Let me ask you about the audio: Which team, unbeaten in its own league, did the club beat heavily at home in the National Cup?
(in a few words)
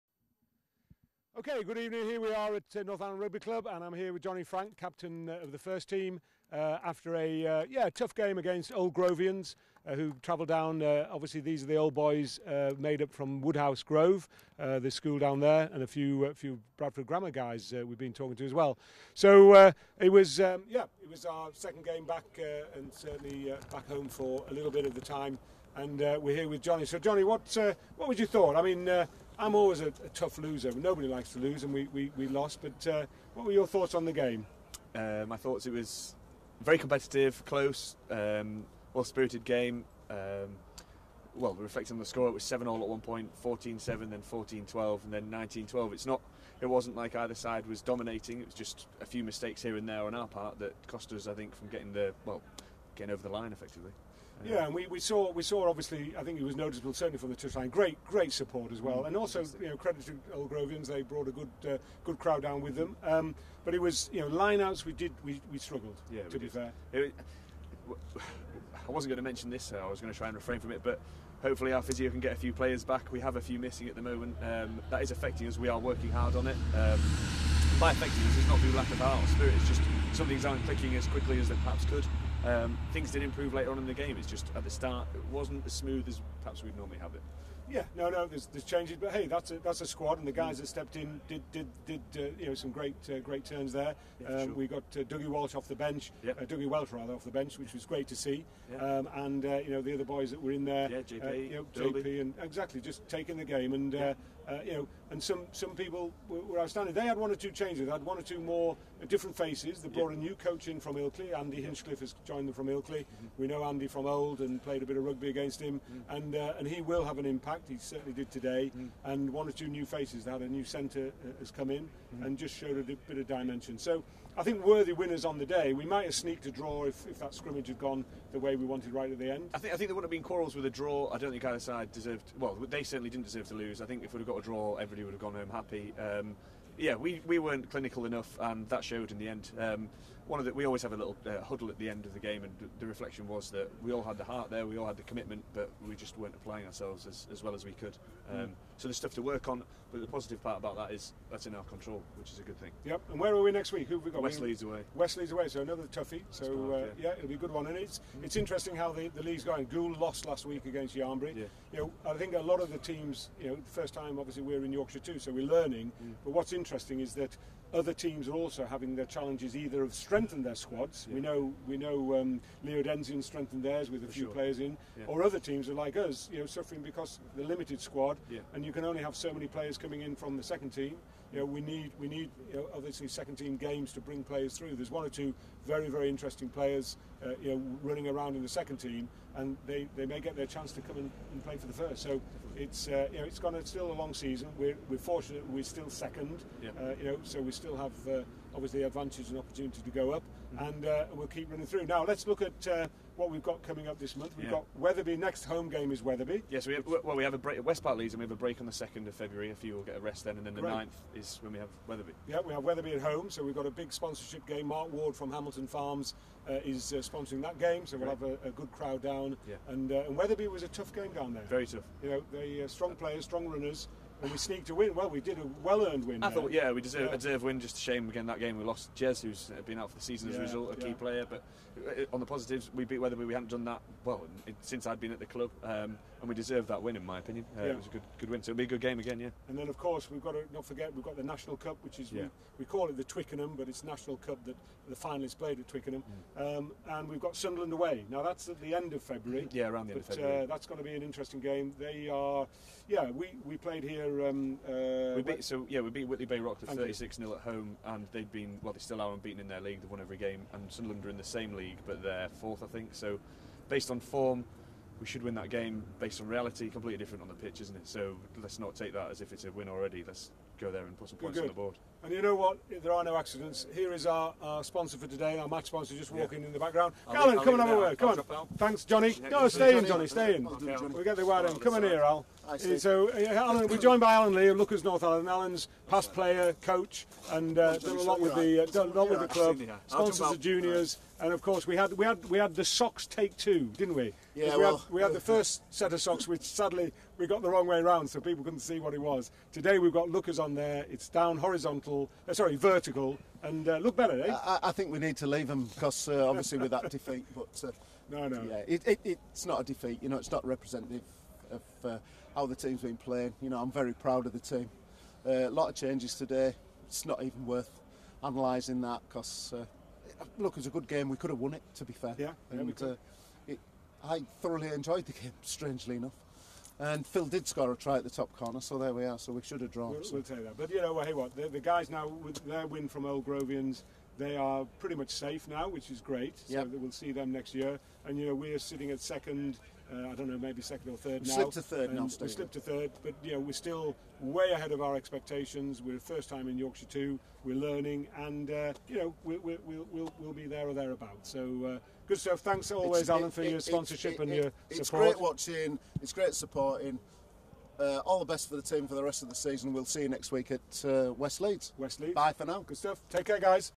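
Whitley Bay.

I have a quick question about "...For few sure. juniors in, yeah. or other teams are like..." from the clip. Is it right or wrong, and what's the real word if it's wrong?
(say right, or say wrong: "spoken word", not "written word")
wrong: "players", not "juniors".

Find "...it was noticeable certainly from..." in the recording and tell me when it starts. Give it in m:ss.
0:56.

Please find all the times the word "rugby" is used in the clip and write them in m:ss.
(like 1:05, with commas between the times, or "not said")
0:03, 1:55.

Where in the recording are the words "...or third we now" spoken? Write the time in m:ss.
5:40.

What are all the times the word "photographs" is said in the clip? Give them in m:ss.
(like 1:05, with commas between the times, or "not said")
not said.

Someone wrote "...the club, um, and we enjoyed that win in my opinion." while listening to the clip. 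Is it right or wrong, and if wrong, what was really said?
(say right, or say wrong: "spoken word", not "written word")
wrong: "deserved", not "enjoyed".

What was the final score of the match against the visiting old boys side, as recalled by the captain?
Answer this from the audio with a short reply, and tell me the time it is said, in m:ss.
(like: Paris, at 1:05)
19-12, at 0:45.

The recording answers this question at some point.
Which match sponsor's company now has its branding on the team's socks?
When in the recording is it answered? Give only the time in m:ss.
4:44.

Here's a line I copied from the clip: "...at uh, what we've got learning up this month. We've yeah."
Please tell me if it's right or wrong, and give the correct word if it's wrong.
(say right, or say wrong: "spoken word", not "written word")
wrong: "coming", not "learning".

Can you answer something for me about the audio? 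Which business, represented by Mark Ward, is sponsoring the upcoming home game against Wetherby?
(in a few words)
Hamilton Farms.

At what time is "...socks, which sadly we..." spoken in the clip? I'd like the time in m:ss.
4:56.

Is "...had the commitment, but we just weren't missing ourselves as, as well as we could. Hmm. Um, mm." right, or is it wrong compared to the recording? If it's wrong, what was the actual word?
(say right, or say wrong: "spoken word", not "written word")
wrong: "applying", not "missing".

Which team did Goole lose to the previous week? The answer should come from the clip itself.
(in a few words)
Yarnbury.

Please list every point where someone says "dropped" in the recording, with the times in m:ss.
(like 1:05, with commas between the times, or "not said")
not said.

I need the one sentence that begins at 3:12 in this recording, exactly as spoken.
So it's, uh, you know, it's gone still a long season.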